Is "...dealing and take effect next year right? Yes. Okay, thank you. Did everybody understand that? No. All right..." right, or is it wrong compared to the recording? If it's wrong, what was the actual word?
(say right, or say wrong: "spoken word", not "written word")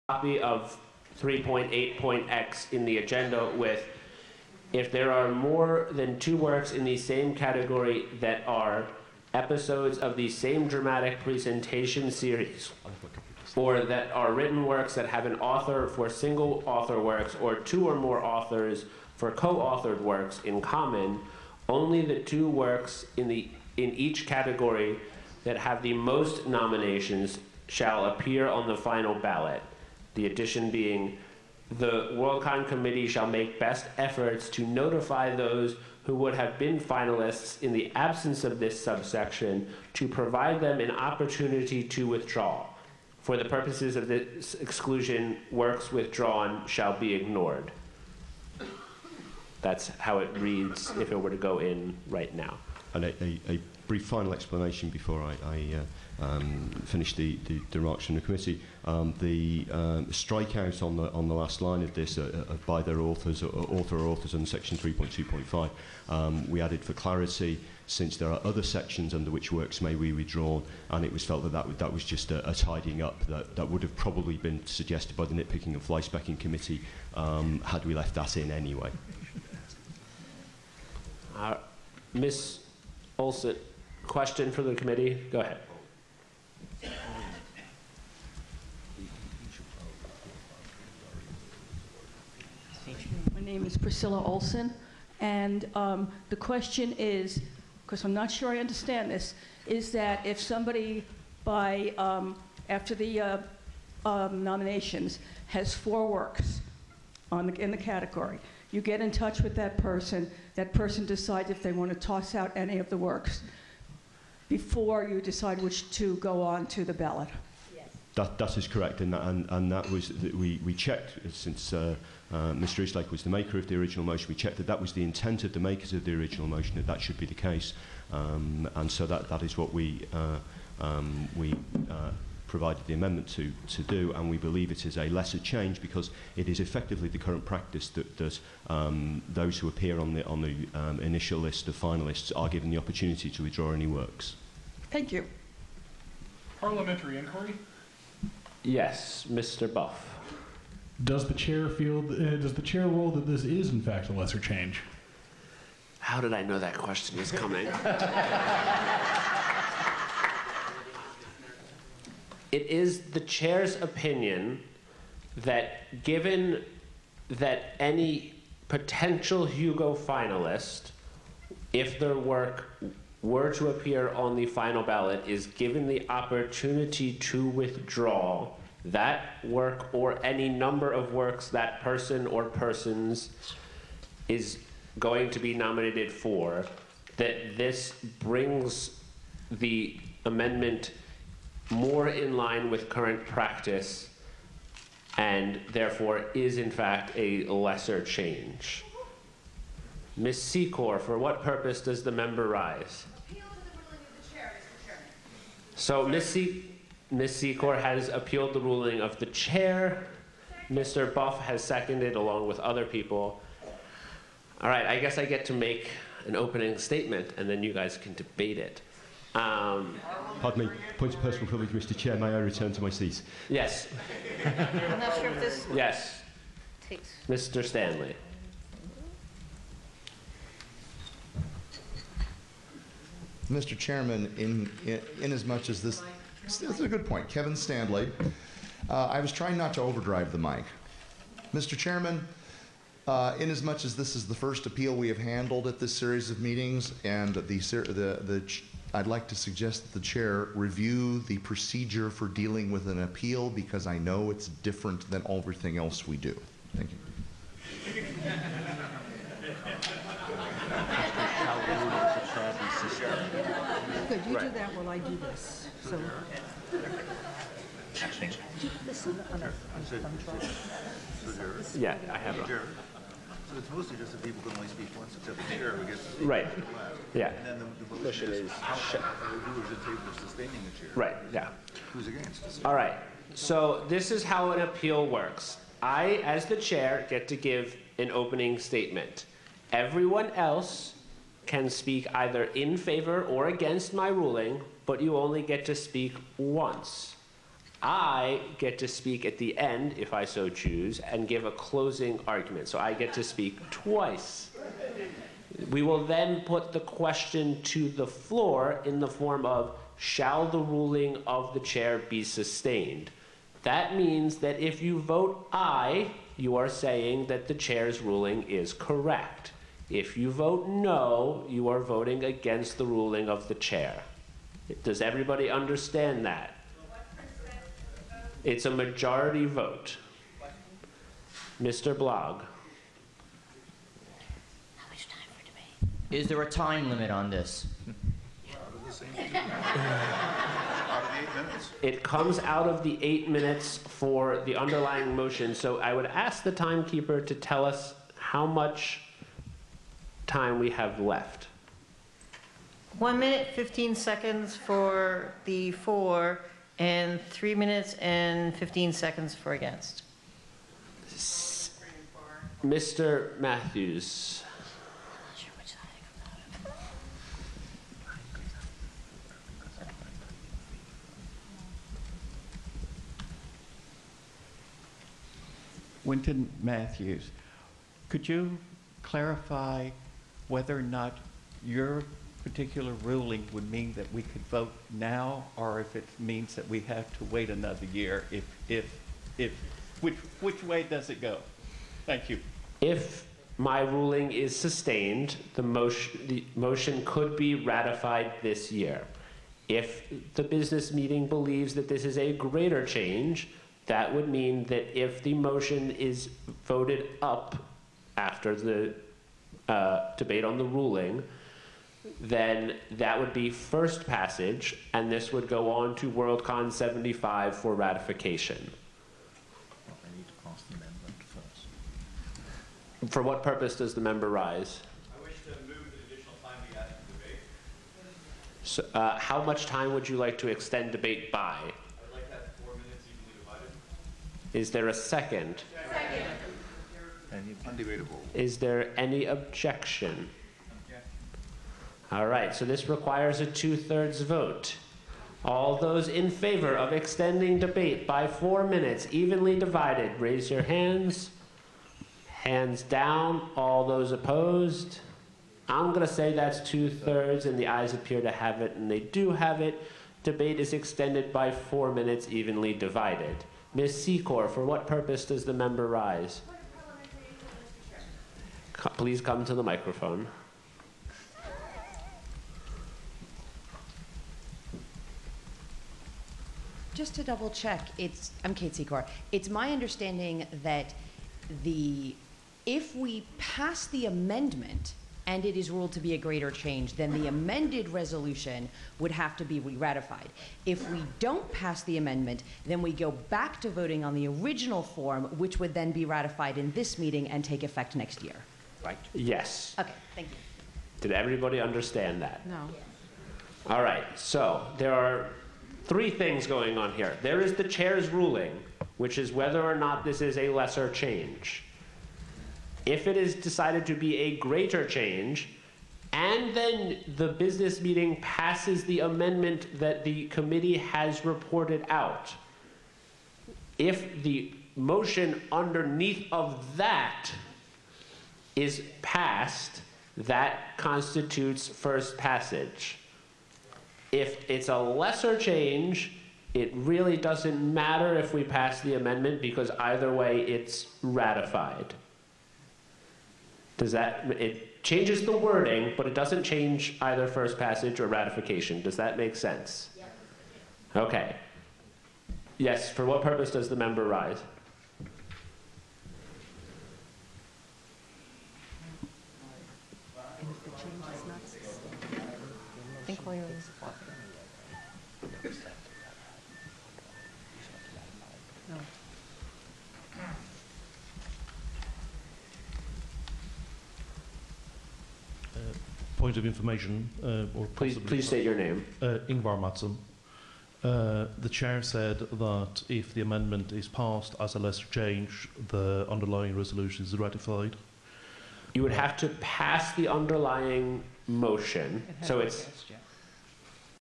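wrong: "meeting", not "dealing".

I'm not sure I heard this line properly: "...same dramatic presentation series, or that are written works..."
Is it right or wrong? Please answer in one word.
right.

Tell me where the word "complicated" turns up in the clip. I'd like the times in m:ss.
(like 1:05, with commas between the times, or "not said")
not said.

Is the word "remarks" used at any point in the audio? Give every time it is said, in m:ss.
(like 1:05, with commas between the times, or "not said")
0:57.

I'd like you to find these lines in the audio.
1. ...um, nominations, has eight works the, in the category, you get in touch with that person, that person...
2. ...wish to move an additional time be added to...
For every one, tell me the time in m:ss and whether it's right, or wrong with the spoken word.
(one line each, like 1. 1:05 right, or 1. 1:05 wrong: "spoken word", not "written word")
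1. 1:44 wrong: "four", not "eight"
2. 7:05 right.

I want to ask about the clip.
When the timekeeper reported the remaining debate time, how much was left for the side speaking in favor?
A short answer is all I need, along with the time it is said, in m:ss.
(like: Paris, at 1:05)
1 minute 15 seconds, at 5:52.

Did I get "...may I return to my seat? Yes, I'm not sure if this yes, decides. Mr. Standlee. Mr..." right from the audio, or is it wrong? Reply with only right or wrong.
wrong.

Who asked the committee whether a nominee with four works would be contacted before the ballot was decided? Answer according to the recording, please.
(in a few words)
Priscilla Olson.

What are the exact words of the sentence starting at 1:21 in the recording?
Uh, Miss Olson Question for the committee?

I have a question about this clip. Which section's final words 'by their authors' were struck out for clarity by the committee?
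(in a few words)
3.2.5.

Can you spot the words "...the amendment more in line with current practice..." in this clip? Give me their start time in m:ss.
3:09.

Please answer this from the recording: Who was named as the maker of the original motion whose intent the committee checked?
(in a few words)
Mr. Eastlake.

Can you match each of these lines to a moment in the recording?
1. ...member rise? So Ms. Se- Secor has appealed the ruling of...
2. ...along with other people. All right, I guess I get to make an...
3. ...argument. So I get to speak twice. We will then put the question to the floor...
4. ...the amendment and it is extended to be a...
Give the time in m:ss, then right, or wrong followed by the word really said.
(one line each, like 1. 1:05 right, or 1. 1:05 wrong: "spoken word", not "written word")
1. 3:22 right
2. 3:32 right
3. 5:02 right
4. 8:03 wrong: "ruled", not "extended".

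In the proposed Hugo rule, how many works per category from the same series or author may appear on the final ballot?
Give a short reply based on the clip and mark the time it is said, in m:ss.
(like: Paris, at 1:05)
2, at 0:21.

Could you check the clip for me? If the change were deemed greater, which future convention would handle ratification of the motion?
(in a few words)
WorldCon 75.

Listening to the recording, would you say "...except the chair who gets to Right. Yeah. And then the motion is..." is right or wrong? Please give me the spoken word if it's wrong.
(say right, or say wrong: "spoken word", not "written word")
right.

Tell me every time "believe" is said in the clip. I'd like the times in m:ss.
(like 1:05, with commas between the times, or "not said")
2:14, 6:41.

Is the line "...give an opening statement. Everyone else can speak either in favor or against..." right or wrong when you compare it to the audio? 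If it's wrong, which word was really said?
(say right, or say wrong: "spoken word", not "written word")
right.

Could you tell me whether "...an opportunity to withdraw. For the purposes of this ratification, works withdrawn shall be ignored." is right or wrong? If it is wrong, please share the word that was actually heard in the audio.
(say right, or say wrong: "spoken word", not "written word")
wrong: "exclusion", not "ratification".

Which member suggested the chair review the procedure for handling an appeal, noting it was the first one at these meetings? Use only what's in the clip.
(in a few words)
Kevin Standlee.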